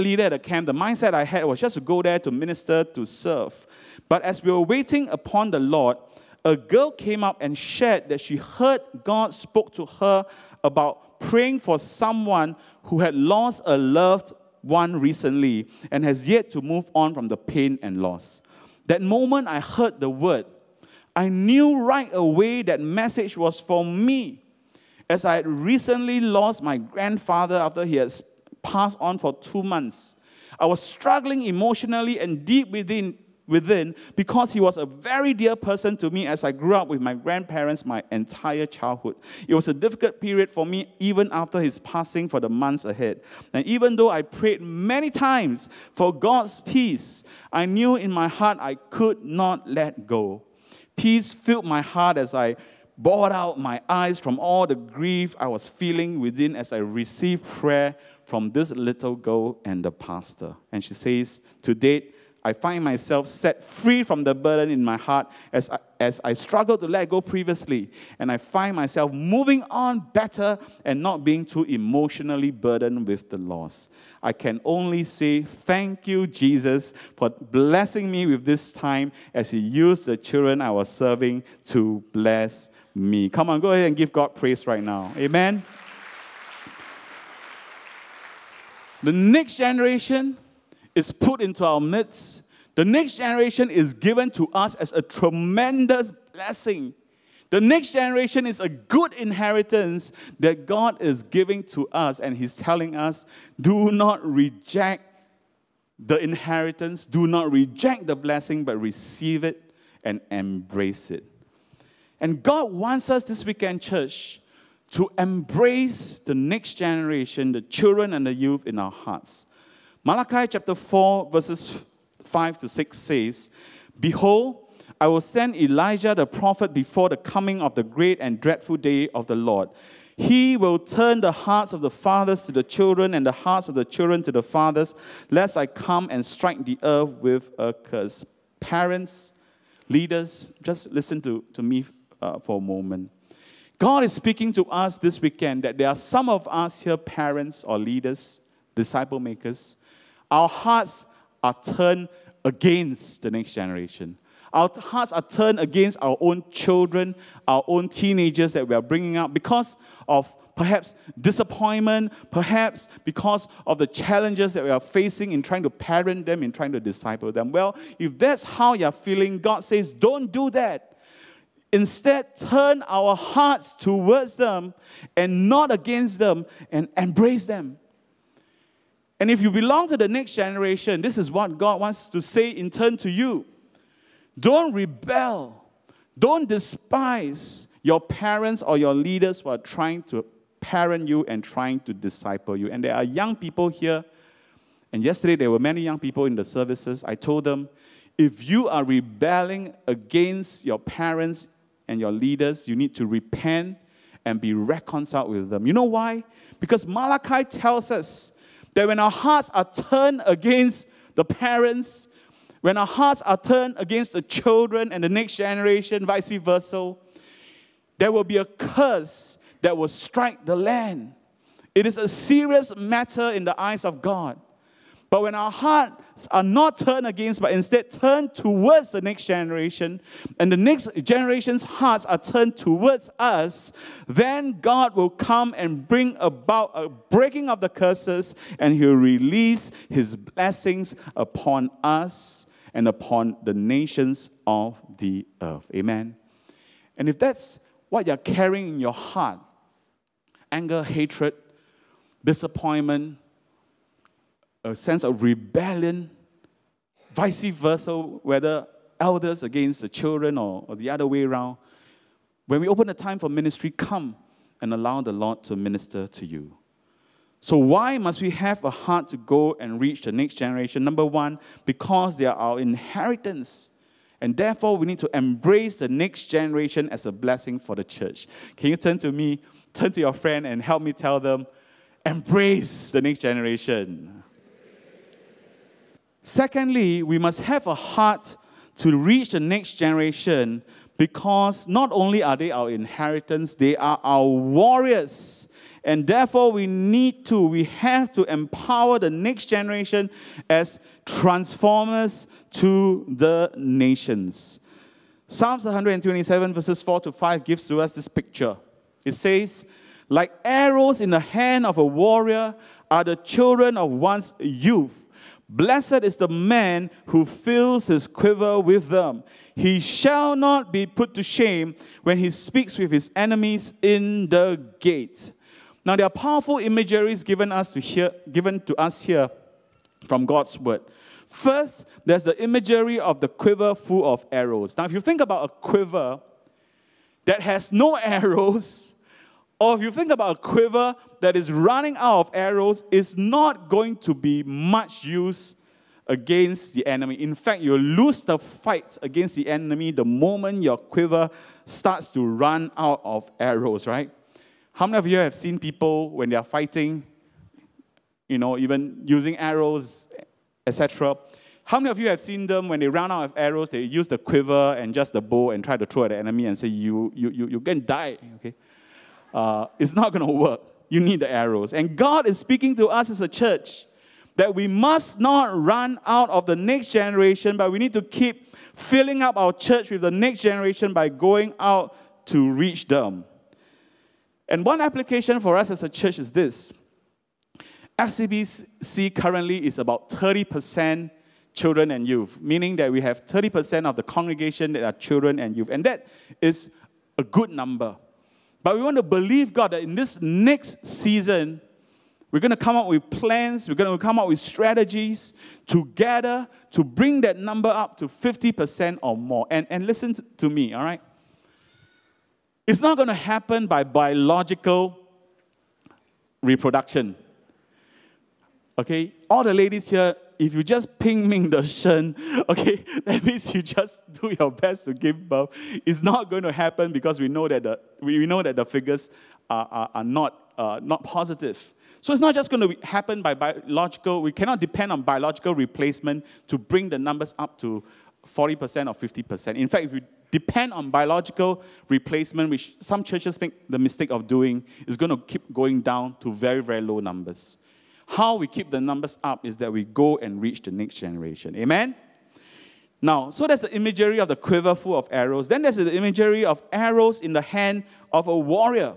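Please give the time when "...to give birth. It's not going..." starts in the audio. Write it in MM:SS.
07:04.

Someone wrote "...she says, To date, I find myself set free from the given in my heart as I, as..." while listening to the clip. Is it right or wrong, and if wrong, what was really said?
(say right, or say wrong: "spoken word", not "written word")
wrong: "burden", not "given".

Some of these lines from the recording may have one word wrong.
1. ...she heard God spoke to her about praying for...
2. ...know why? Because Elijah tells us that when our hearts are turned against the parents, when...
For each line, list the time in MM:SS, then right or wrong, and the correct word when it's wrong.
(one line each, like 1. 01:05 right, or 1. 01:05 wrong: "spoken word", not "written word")
1. 00:08 right
2. 03:25 wrong: "Malachi", not "Elijah".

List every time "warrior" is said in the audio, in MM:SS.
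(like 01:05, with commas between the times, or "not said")
04:54, 05:11, 07:38.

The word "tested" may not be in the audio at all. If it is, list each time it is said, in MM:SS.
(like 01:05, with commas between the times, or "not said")
not said.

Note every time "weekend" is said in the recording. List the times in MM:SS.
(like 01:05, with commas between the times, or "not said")
01:53, 02:25.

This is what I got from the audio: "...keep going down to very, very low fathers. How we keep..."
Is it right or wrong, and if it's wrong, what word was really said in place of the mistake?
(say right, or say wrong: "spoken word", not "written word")
wrong: "numbers", not "fathers".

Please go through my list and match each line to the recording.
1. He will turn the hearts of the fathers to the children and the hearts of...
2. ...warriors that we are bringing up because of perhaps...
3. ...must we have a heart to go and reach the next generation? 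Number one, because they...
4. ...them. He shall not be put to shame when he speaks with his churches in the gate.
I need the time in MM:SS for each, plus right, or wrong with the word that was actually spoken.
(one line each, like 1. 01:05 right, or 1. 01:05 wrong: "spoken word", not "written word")
1. 02:10 right
2. 02:37 wrong: "teenagers", not "warriors"
3. 04:27 right
4. 05:18 wrong: "enemies", not "churches".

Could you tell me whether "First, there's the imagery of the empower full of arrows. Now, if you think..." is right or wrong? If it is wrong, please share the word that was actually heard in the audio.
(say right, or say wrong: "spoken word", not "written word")
wrong: "quiver", not "empower".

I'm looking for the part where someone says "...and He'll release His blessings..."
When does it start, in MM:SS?
03:58.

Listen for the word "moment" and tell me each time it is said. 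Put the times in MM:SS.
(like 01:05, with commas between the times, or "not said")
00:19, 02:22, 05:50.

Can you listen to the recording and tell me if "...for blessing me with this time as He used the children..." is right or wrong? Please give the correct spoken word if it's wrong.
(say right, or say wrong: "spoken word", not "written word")
right.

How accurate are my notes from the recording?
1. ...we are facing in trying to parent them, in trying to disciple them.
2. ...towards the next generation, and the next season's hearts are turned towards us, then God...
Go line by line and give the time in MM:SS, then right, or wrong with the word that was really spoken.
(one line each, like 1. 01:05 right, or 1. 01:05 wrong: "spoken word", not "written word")
1. 02:44 right
2. 03:48 wrong: "generation", not "season".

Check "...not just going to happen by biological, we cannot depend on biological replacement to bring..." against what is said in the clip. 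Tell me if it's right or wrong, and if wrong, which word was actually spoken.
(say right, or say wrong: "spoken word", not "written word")
right.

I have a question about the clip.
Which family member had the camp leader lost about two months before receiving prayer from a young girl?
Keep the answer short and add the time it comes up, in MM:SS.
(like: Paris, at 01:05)
grandfather, at 00:26.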